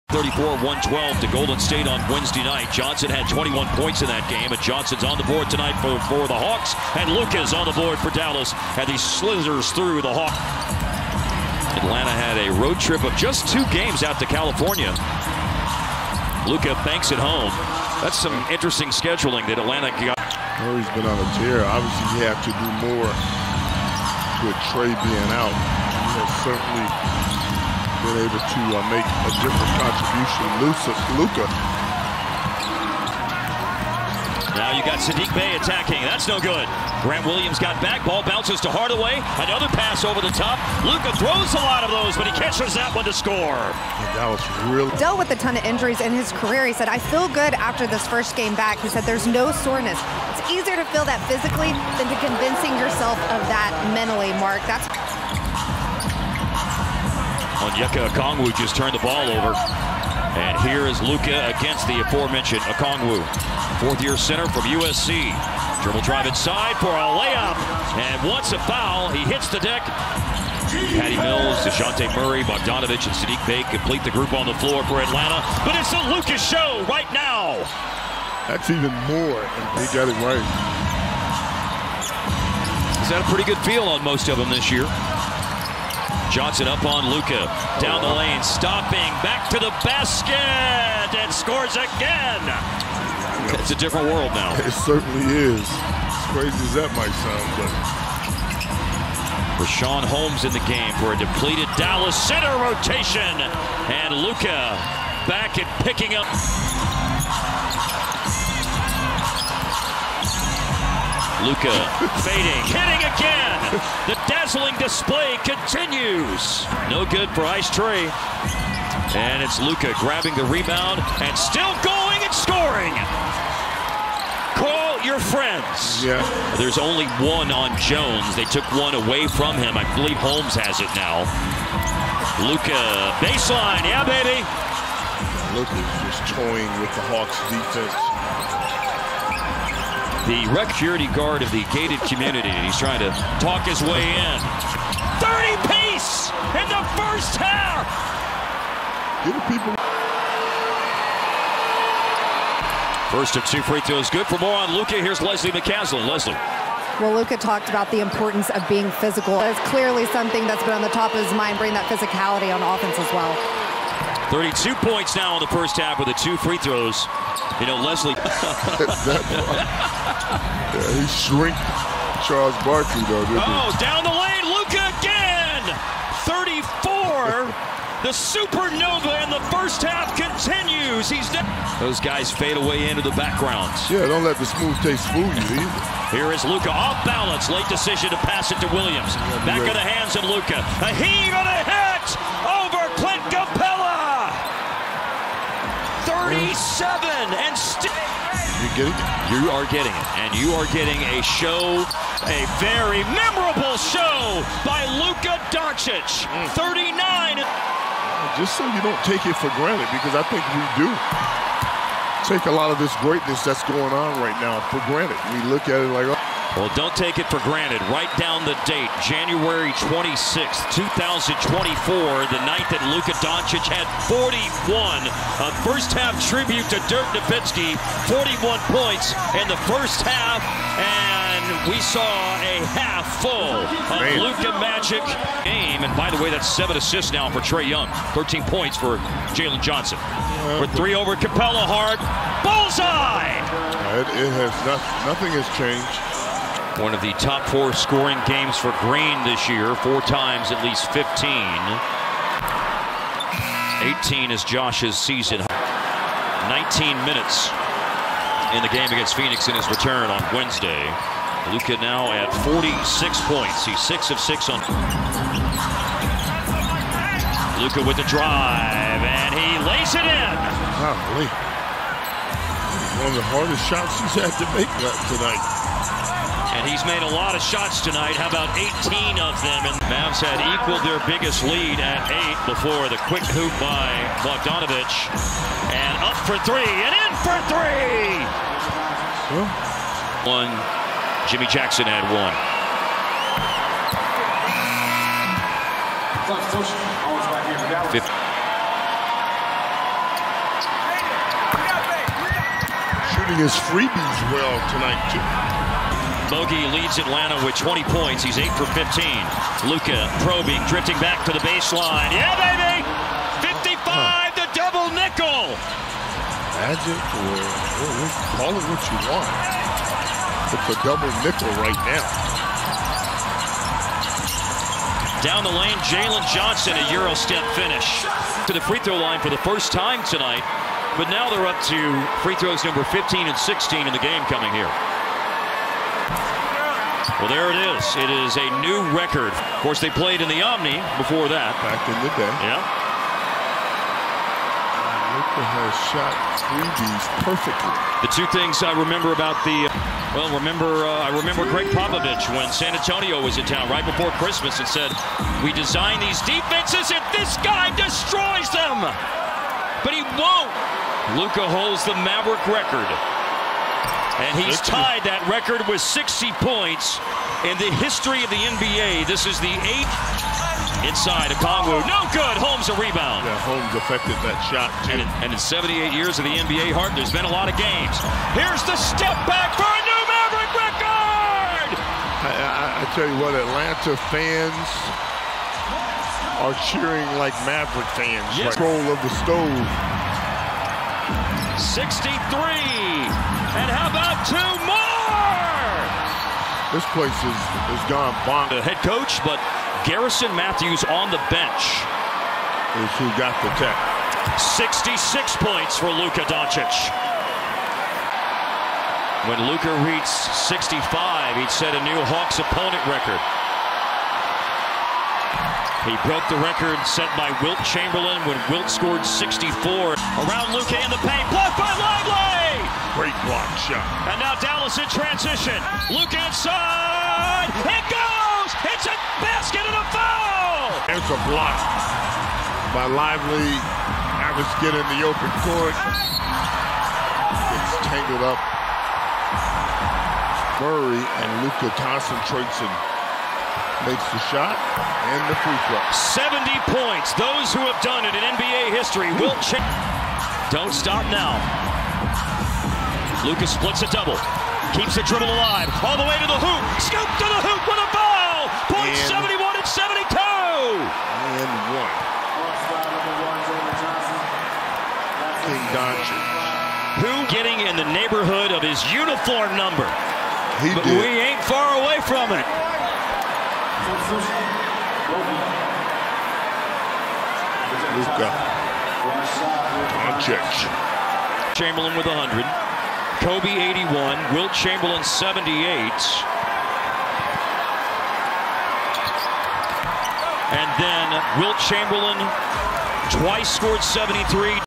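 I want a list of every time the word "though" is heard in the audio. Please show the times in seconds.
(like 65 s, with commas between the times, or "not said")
173 s.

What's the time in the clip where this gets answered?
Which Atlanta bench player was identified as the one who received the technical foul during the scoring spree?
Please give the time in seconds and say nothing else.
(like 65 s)
399 s.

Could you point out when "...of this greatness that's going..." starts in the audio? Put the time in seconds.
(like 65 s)
212 s.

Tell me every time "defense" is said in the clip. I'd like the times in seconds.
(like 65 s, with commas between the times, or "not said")
137 s, 356 s.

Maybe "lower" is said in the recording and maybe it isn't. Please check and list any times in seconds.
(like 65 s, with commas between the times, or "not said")
not said.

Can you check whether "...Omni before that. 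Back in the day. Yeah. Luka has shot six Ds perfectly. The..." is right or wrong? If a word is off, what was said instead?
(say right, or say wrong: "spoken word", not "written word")
wrong: "three", not "six".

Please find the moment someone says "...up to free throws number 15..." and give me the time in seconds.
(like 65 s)
331 s.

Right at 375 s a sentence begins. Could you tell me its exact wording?
And in, and in 78 years of the NBA, Hart, there's been a lot of games.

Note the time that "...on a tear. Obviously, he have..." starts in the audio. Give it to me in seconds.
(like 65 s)
21 s.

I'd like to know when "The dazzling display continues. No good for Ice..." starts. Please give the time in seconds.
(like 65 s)
114 s.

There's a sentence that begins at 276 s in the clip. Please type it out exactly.
And he's made a lot of shots tonight.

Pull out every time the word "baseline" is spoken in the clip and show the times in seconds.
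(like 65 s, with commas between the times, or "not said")
133 s, 311 s.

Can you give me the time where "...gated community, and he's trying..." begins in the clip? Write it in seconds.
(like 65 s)
141 s.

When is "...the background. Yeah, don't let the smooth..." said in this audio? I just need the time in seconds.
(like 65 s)
183 s.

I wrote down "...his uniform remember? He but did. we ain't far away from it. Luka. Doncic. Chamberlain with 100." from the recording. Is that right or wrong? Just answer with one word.
wrong.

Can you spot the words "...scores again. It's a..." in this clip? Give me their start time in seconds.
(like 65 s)
91 s.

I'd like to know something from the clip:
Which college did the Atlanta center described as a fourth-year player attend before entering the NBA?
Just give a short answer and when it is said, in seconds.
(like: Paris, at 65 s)
USC, at 64 s.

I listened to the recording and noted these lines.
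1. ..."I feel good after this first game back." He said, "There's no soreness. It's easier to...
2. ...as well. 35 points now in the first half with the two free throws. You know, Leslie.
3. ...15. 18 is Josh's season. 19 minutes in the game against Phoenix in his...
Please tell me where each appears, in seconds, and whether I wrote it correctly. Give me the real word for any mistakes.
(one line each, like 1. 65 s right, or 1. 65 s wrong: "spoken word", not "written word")
1. 46 s right
2. 162 s wrong: "32", not "35"
3. 250 s right.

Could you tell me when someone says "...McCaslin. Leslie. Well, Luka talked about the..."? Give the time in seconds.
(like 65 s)
155 s.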